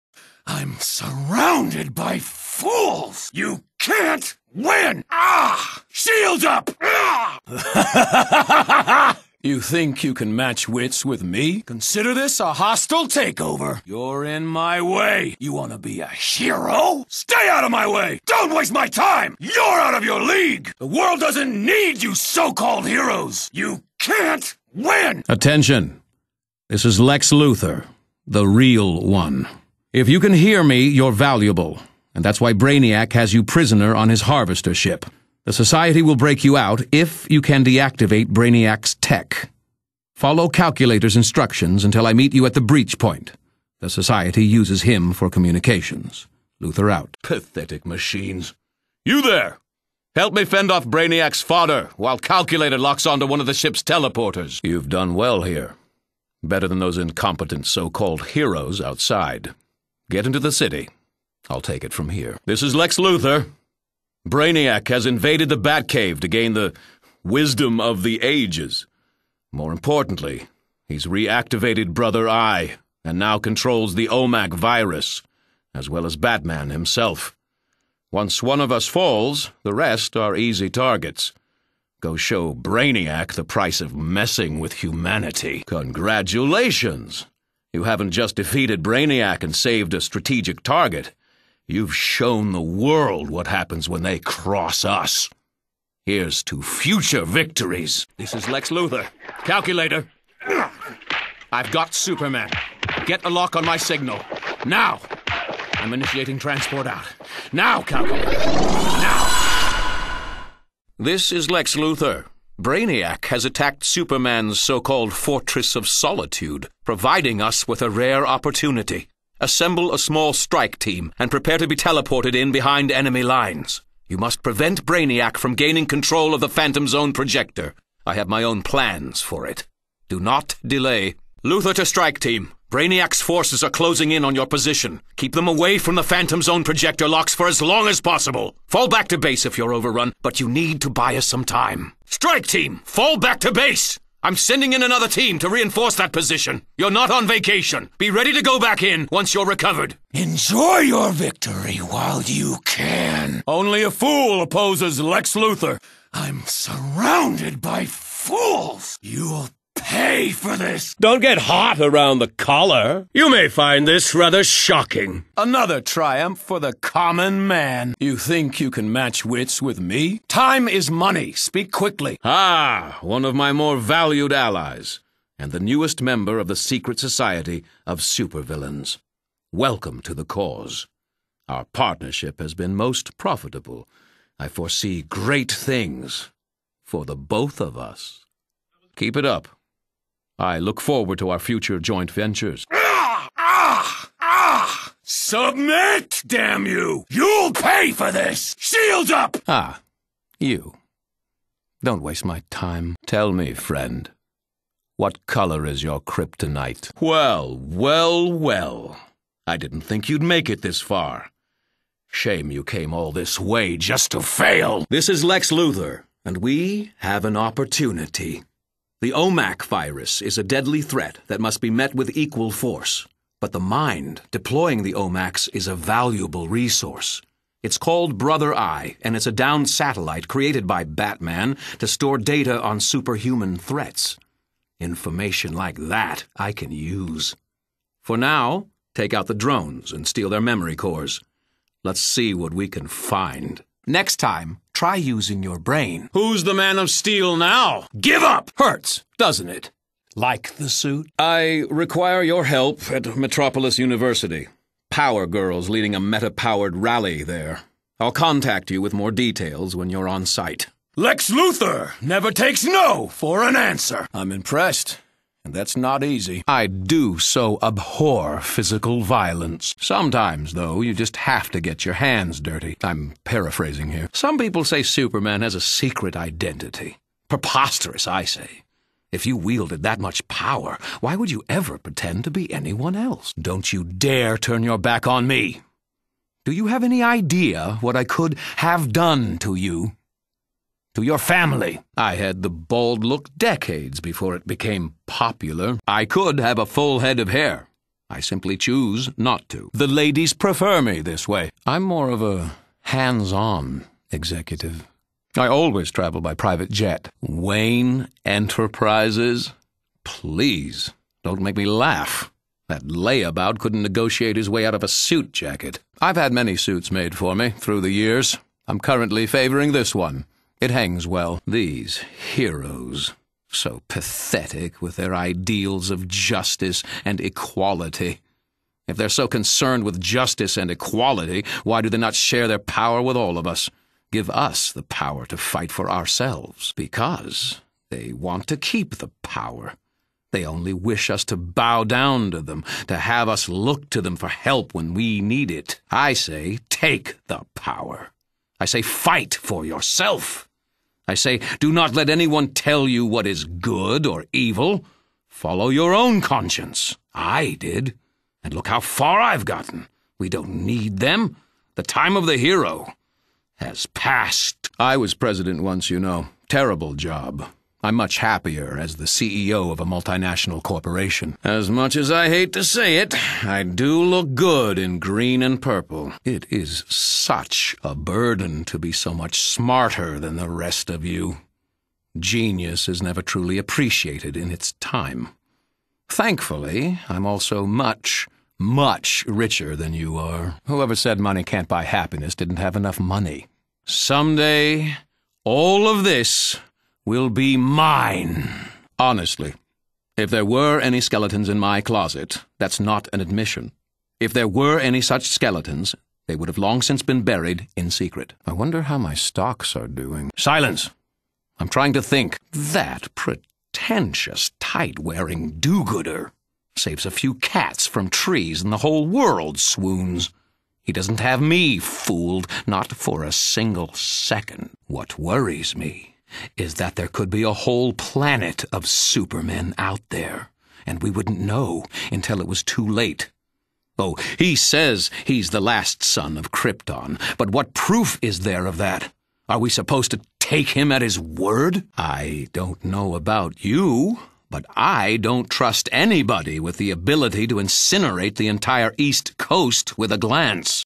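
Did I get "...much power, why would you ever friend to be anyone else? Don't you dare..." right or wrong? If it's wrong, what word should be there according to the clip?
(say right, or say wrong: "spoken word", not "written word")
wrong: "pretend", not "friend".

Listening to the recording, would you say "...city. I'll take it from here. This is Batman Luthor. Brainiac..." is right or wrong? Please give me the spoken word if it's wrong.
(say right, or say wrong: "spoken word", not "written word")
wrong: "Lex", not "Batman".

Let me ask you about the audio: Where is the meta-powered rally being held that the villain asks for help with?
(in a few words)
Metropolis University.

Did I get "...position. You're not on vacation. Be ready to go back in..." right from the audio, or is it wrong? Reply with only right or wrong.
right.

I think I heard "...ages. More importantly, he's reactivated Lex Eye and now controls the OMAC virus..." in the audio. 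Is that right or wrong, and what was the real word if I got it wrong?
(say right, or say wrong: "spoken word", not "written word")
wrong: "Brother", not "Lex".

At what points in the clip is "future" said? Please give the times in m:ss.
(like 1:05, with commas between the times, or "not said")
1:36, 3:11.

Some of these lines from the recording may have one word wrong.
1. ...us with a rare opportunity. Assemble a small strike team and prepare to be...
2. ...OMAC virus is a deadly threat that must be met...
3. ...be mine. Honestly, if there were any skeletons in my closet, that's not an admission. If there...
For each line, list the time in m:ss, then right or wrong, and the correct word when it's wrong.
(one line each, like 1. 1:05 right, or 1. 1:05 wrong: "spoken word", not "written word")
1. 1:57 right
2. 3:39 right
3. 6:37 right.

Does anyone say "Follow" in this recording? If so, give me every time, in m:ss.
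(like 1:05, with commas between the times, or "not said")
0:40, 5:55.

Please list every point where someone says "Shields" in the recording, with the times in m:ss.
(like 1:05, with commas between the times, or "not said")
0:05, 3:18.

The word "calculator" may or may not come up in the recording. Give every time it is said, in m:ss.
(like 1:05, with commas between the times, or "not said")
0:40, 0:52, 1:39, 1:47.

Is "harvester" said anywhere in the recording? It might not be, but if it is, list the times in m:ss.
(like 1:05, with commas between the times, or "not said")
0:34.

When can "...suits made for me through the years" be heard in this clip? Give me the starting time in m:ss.
5:16.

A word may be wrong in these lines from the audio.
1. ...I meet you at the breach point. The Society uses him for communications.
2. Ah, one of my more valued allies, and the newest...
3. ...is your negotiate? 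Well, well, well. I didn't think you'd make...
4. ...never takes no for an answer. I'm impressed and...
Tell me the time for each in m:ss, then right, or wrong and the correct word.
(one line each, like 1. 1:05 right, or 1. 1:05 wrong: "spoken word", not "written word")
1. 0:42 right
2. 2:52 right
3. 3:25 wrong: "kryptonite", not "negotiate"
4. 4:22 right.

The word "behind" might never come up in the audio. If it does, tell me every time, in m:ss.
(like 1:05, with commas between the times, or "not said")
2:02.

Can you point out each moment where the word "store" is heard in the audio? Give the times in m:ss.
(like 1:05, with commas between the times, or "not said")
3:51.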